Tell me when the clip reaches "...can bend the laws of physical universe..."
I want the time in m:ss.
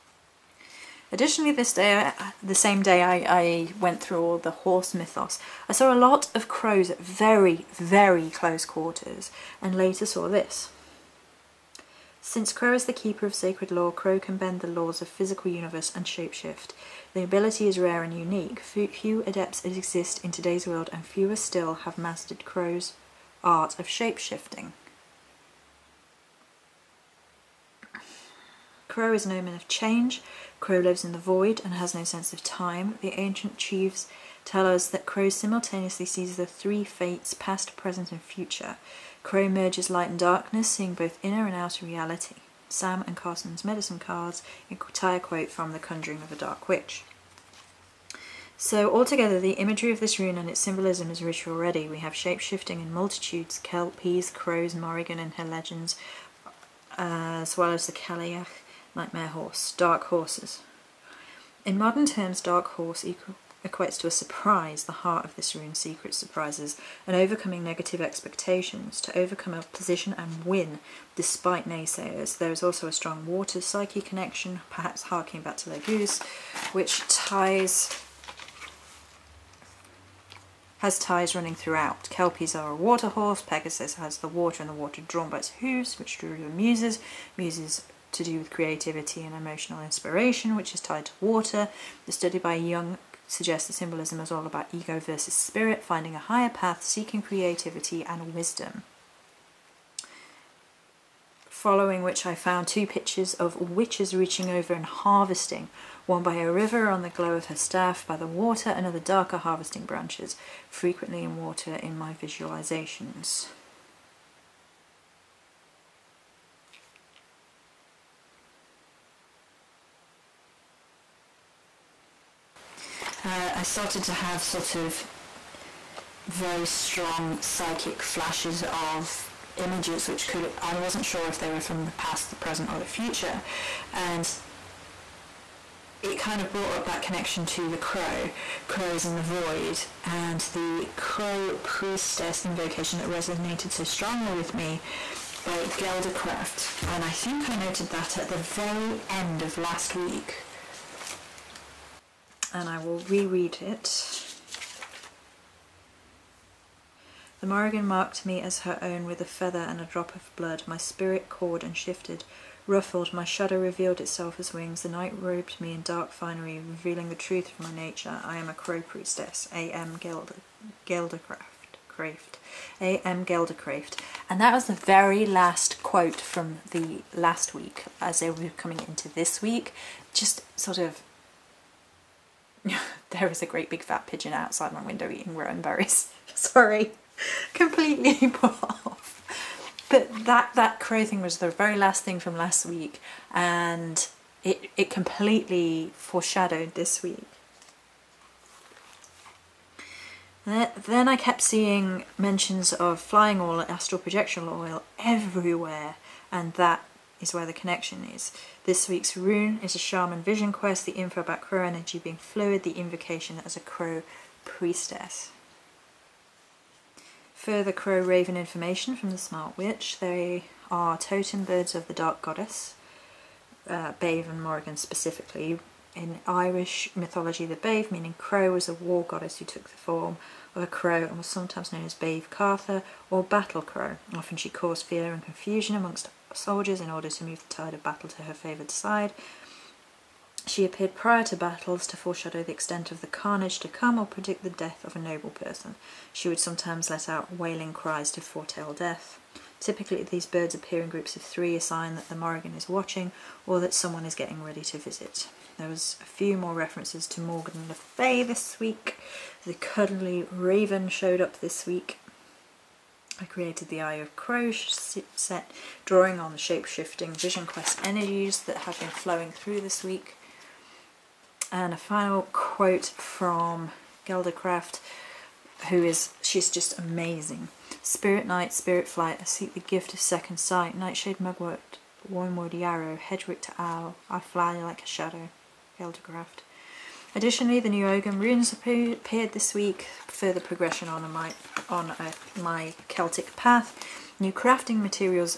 0:14.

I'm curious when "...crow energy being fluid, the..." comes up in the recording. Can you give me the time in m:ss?
3:31.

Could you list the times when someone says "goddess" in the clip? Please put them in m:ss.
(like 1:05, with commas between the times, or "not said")
3:42, 3:49.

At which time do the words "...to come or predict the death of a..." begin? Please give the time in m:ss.
4:03.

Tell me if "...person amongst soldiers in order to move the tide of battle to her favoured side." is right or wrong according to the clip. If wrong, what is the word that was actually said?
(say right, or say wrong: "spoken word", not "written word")
wrong: "confusion", not "person".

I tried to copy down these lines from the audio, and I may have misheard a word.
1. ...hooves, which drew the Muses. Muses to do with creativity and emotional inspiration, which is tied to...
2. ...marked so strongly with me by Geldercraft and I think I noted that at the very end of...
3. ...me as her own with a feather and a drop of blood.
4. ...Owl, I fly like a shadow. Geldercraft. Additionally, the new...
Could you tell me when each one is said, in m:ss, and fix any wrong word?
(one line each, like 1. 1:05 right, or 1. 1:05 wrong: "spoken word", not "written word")
1. 1:25 right
2. 2:23 wrong: "resonated", not "marked"
3. 2:38 right
4. 4:43 right.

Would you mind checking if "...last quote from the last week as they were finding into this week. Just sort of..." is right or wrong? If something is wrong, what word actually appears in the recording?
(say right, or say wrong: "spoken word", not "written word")
wrong: "coming", not "finding".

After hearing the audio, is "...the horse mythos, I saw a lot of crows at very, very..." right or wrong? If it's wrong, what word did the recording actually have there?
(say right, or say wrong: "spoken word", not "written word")
right.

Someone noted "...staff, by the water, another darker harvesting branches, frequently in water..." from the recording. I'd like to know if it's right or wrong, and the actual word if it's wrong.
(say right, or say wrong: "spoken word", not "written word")
right.